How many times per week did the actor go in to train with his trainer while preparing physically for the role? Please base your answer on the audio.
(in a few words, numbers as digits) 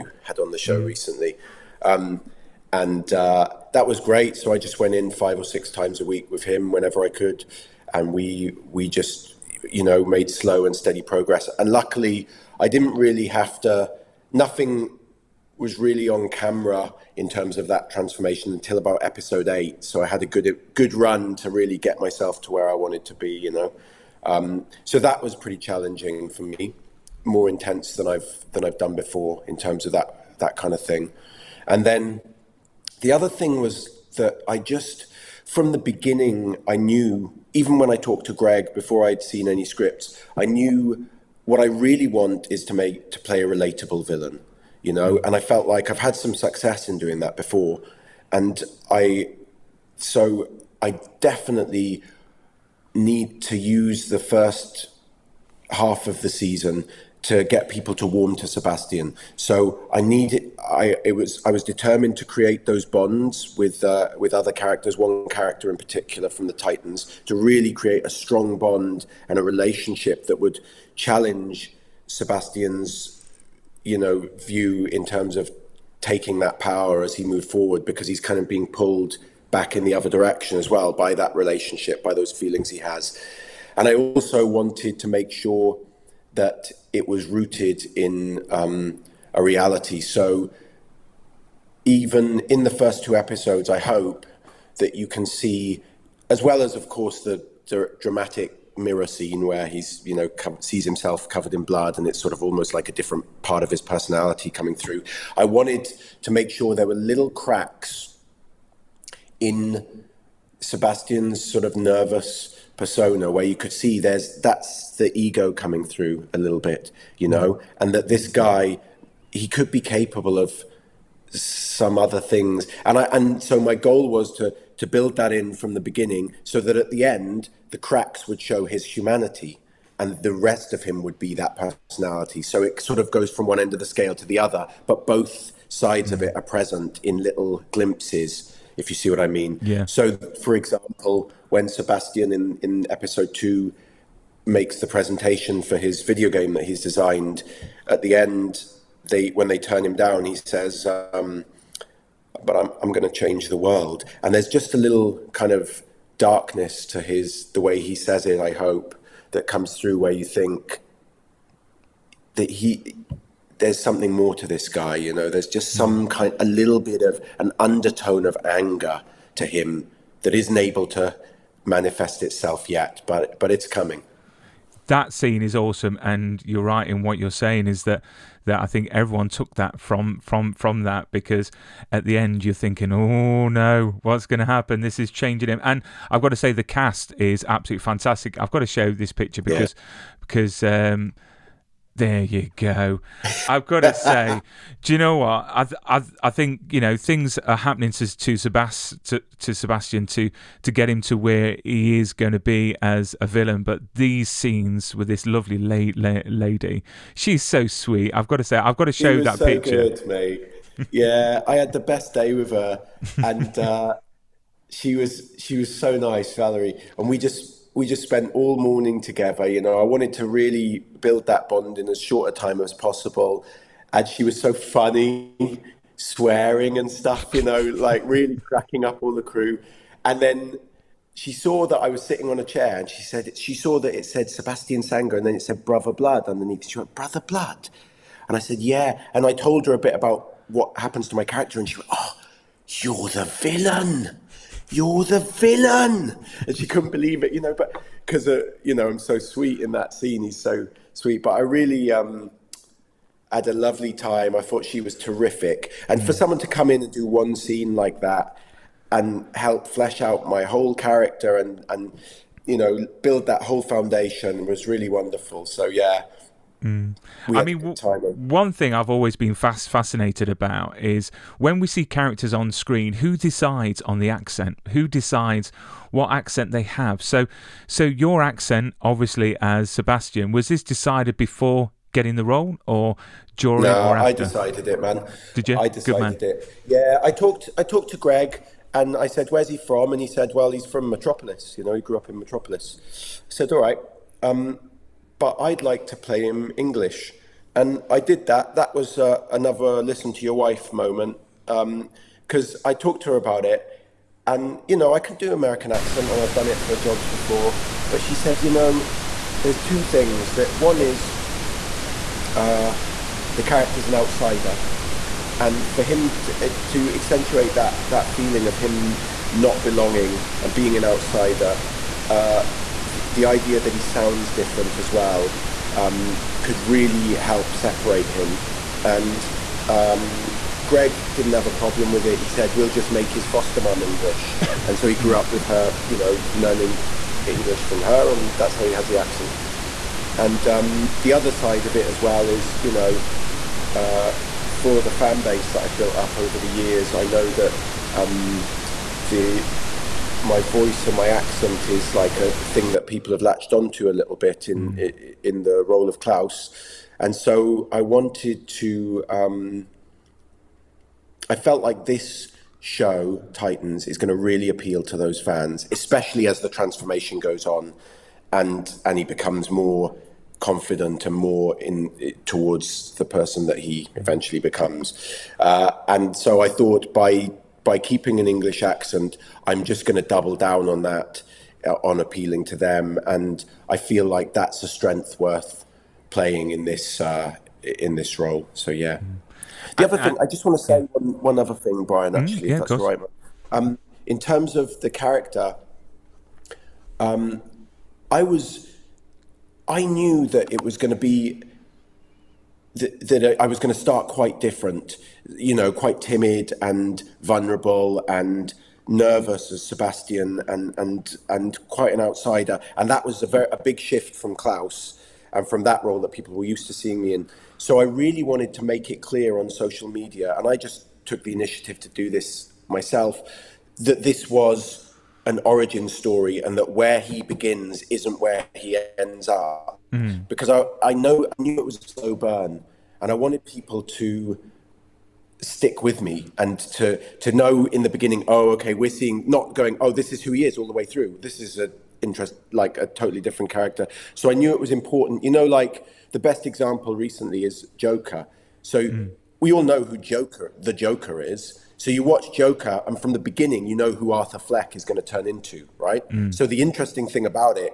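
5 or 6.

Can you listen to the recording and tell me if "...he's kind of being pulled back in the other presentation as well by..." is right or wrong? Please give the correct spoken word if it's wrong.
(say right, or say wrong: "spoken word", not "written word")
wrong: "direction", not "presentation".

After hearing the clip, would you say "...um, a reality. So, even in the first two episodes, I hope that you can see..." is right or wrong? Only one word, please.
right.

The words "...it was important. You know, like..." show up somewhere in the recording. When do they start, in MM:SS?
07:24.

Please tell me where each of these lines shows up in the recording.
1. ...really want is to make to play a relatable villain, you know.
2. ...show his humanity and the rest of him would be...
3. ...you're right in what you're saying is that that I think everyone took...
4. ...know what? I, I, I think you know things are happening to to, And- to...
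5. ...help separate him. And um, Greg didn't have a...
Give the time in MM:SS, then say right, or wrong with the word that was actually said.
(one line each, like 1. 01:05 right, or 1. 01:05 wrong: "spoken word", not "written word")
1. 00:41 right
2. 02:08 right
3. 02:56 right
4. 03:14 wrong: "Sebast", not "And"
5. 05:27 right.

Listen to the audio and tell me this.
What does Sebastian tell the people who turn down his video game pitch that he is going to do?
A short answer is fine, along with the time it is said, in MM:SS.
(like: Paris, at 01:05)
Change the world, at 02:33.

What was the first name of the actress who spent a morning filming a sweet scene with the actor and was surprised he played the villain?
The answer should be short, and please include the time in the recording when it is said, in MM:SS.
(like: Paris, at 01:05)
Valerie, at 03:36.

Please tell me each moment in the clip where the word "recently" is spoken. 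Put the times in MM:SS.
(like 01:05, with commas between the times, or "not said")
00:00, 07:26.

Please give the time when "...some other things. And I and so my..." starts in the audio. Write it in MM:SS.
02:01.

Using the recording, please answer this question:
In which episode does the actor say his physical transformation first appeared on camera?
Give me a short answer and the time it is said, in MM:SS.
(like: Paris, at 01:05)
Episode 8, at 00:19.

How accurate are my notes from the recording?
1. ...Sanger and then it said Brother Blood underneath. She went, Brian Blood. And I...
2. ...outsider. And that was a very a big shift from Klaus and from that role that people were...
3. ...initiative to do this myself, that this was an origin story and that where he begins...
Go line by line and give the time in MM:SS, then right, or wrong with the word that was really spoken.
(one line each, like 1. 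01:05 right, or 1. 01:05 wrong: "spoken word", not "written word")
1. 03:54 wrong: "Brother", not "Brian"
2. 06:51 right
3. 07:01 right.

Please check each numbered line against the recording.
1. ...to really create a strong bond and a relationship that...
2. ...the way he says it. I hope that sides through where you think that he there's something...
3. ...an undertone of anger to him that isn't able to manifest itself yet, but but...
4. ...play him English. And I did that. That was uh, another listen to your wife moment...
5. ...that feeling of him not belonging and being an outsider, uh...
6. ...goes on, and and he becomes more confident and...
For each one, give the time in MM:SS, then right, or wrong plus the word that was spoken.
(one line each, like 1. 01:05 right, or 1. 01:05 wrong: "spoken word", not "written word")
1. 01:07 right
2. 02:37 wrong: "comes", not "sides"
3. 02:47 right
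4. 04:55 right
5. 05:17 right
6. 06:07 right.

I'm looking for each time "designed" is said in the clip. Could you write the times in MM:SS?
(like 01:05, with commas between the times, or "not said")
02:26.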